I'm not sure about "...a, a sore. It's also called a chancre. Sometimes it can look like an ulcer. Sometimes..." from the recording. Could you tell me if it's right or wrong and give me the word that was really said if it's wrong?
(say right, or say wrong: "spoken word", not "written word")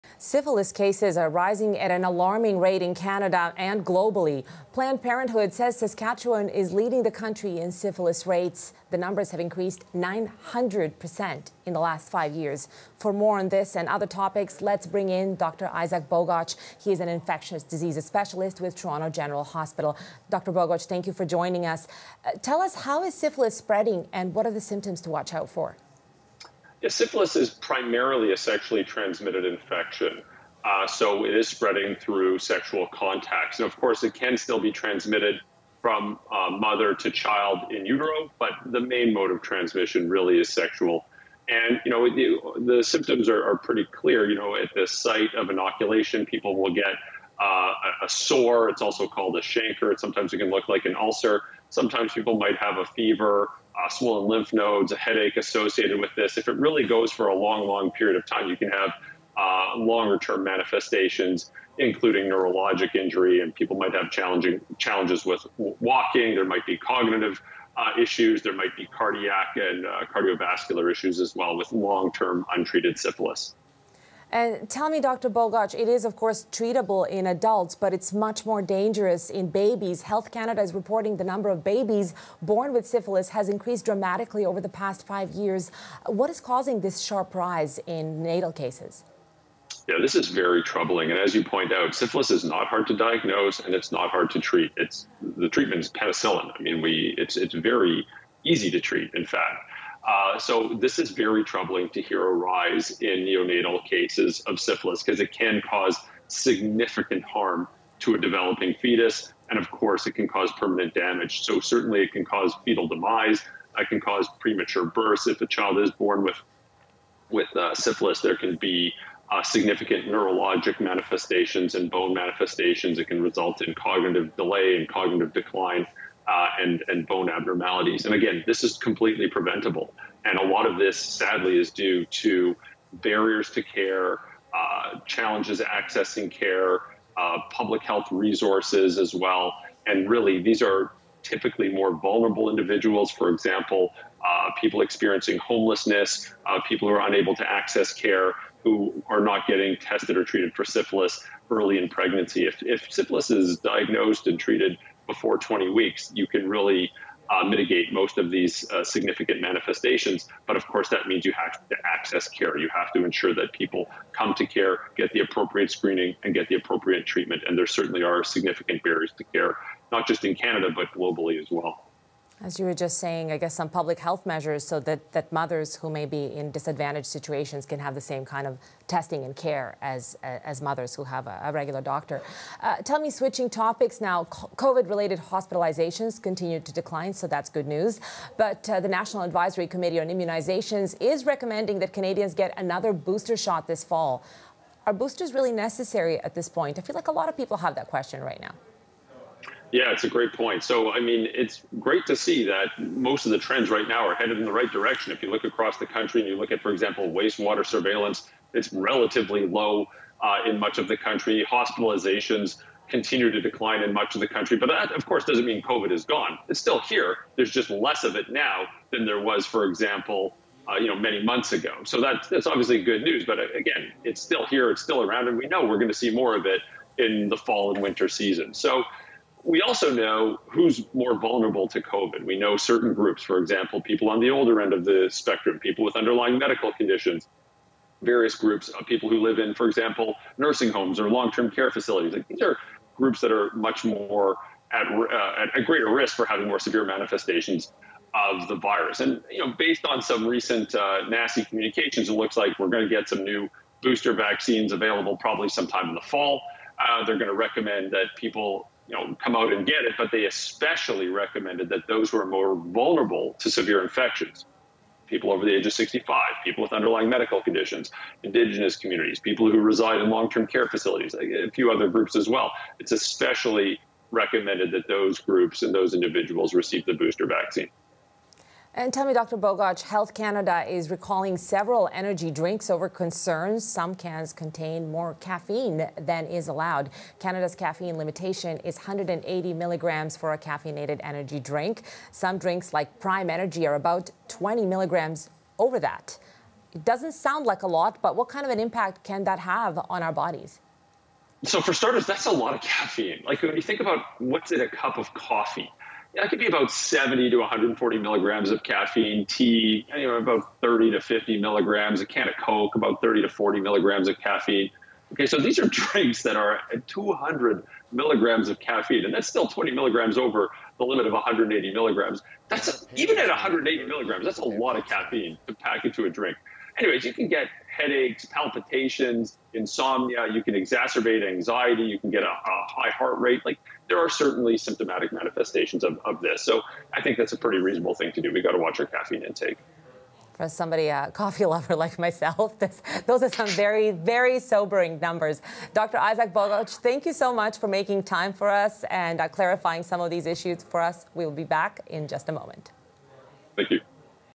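right.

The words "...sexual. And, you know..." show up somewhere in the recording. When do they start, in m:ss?
0:40.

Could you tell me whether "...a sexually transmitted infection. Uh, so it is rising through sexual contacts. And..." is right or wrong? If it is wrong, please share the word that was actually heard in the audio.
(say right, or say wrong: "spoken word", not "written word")
wrong: "spreading", not "rising".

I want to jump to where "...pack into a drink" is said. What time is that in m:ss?
5:25.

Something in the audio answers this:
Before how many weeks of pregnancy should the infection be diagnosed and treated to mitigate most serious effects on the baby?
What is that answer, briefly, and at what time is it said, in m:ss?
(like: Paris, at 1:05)
20 weeks, at 2:35.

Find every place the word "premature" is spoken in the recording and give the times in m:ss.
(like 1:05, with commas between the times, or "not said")
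1:54.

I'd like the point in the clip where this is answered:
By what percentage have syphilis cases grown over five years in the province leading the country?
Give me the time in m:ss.
0:09.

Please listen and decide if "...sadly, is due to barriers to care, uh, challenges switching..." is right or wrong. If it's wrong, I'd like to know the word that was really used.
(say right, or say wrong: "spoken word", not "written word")
wrong: "accessing", not "switching".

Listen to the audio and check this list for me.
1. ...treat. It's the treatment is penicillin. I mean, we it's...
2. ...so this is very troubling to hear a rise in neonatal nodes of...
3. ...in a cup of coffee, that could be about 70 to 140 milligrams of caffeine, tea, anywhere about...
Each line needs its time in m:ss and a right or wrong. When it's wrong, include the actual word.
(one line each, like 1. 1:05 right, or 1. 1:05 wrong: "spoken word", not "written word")
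1. 1:34 right
2. 1:40 wrong: "cases", not "nodes"
3. 5:04 right.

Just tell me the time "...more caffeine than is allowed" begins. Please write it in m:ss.
4:44.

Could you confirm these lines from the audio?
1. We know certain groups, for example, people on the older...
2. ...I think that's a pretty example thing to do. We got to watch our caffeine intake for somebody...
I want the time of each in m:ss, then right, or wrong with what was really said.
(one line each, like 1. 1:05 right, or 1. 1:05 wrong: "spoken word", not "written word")
1. 3:52 right
2. 5:36 wrong: "reasonable", not "example".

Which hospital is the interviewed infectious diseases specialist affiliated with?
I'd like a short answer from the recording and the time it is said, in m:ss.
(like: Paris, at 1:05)
Toronto General Hospital, at 0:18.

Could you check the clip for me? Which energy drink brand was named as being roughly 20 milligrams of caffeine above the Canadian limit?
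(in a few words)
Prime Energy.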